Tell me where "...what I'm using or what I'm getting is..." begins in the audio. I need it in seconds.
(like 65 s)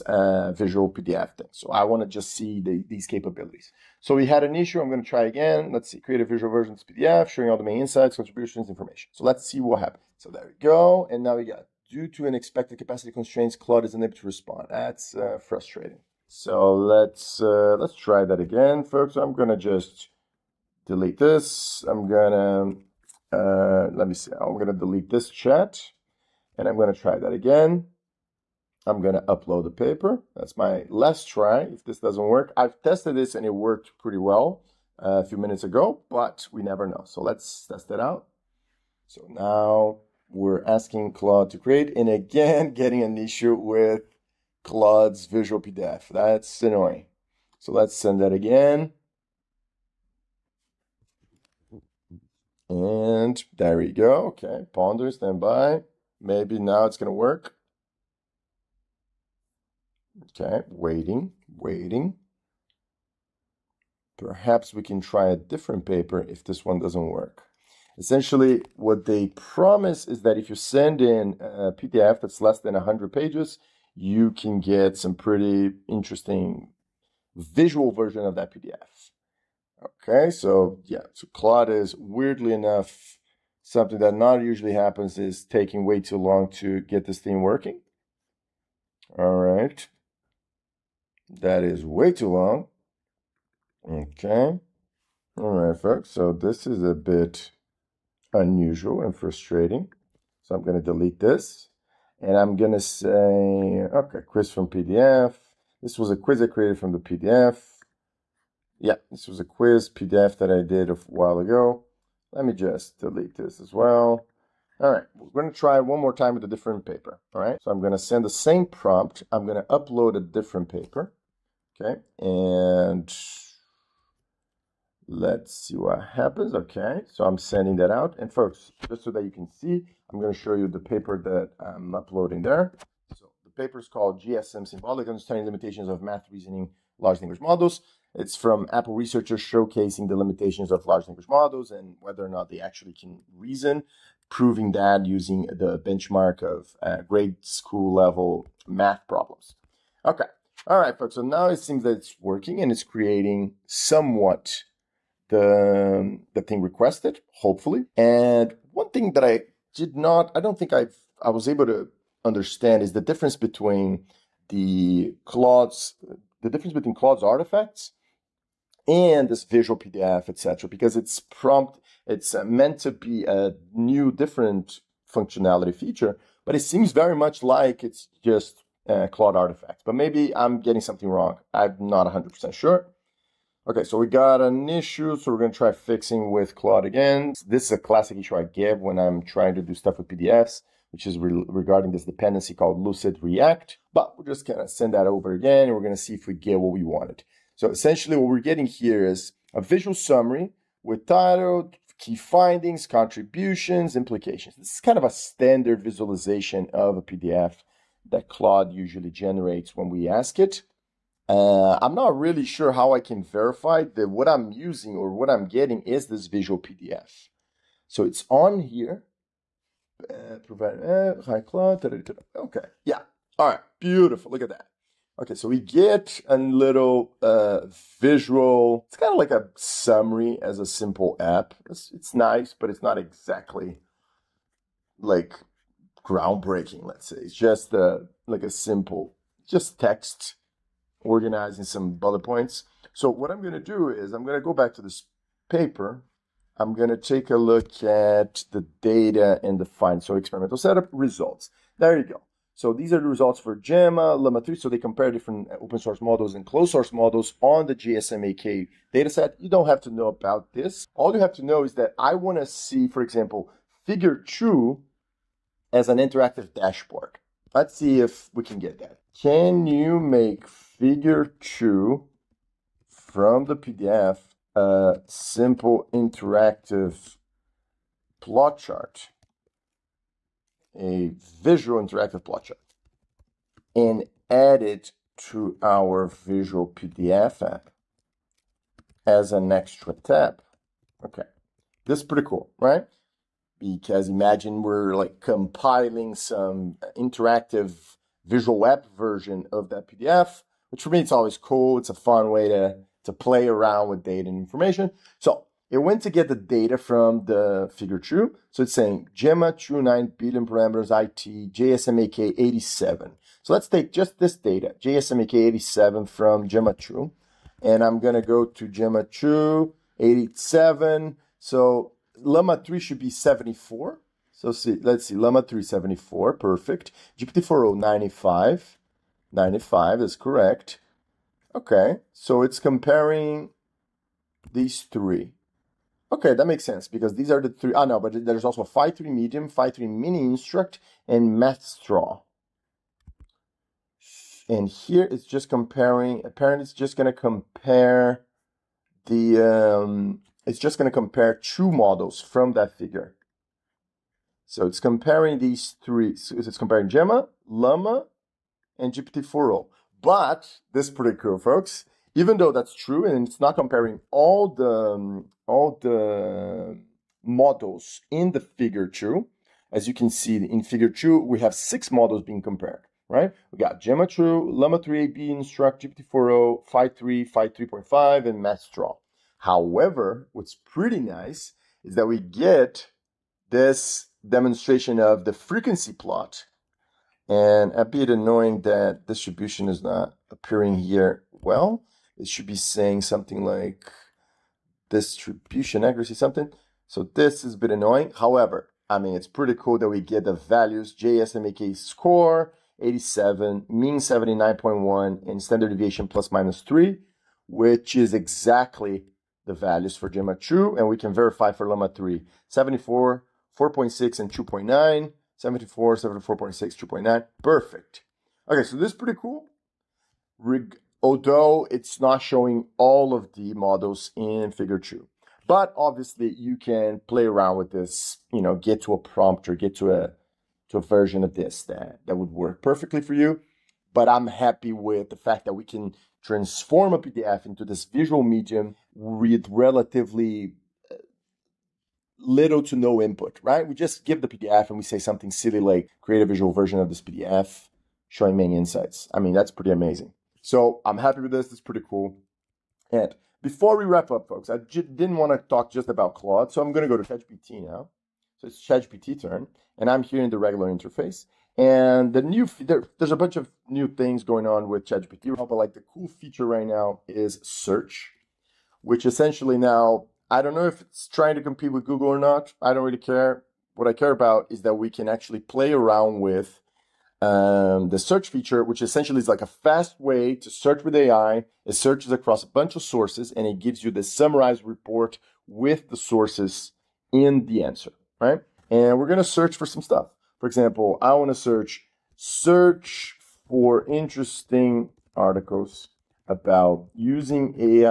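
214 s.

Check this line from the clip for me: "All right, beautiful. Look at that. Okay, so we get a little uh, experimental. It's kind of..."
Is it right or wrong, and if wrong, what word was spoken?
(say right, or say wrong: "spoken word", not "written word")
wrong: "visual", not "experimental".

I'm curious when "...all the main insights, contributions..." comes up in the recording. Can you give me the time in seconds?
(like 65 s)
7 s.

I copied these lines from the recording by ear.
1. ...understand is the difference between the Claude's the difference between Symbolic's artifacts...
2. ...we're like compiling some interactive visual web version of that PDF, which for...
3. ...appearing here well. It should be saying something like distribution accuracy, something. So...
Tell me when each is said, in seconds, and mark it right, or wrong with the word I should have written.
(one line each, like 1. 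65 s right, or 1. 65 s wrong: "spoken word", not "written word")
1. 162 s wrong: "Claude", not "Symbolic"
2. 294 s right
3. 390 s right.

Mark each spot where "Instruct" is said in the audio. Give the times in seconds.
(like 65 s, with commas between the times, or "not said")
340 s, 375 s.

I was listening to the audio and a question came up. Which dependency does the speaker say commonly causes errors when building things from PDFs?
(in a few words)
Lucide React.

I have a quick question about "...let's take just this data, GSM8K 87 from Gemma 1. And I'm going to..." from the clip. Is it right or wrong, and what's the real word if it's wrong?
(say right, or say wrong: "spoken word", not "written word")
wrong: "2", not "1".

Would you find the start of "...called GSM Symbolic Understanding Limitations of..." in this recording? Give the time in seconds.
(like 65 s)
133 s.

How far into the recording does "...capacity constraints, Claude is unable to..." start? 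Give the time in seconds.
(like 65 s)
12 s.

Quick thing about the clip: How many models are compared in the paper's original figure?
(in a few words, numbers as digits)
6.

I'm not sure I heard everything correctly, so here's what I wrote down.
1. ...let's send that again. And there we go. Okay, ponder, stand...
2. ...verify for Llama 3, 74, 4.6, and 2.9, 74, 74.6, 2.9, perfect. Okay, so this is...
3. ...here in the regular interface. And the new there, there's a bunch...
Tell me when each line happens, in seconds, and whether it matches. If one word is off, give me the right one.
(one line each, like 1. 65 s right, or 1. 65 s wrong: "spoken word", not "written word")
1. 47 s right
2. 411 s right
3. 460 s right.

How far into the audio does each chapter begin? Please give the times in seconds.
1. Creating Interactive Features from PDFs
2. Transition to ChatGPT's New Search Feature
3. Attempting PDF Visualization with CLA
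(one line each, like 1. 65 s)
1. 419 s
2. 452 s
3. 146 s.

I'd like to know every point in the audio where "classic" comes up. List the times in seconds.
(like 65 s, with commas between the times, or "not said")
187 s.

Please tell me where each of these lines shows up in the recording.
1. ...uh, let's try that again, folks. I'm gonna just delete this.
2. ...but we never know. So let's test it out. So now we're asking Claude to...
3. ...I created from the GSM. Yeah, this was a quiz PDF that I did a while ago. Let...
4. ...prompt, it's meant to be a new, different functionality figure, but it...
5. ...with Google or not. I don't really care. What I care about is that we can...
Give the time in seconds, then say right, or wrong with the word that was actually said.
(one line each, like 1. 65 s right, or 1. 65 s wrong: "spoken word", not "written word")
1. 17 s right
2. 36 s right
3. 106 s wrong: "PDF", not "GSM"
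4. 171 s wrong: "feature", not "figure"
5. 471 s right.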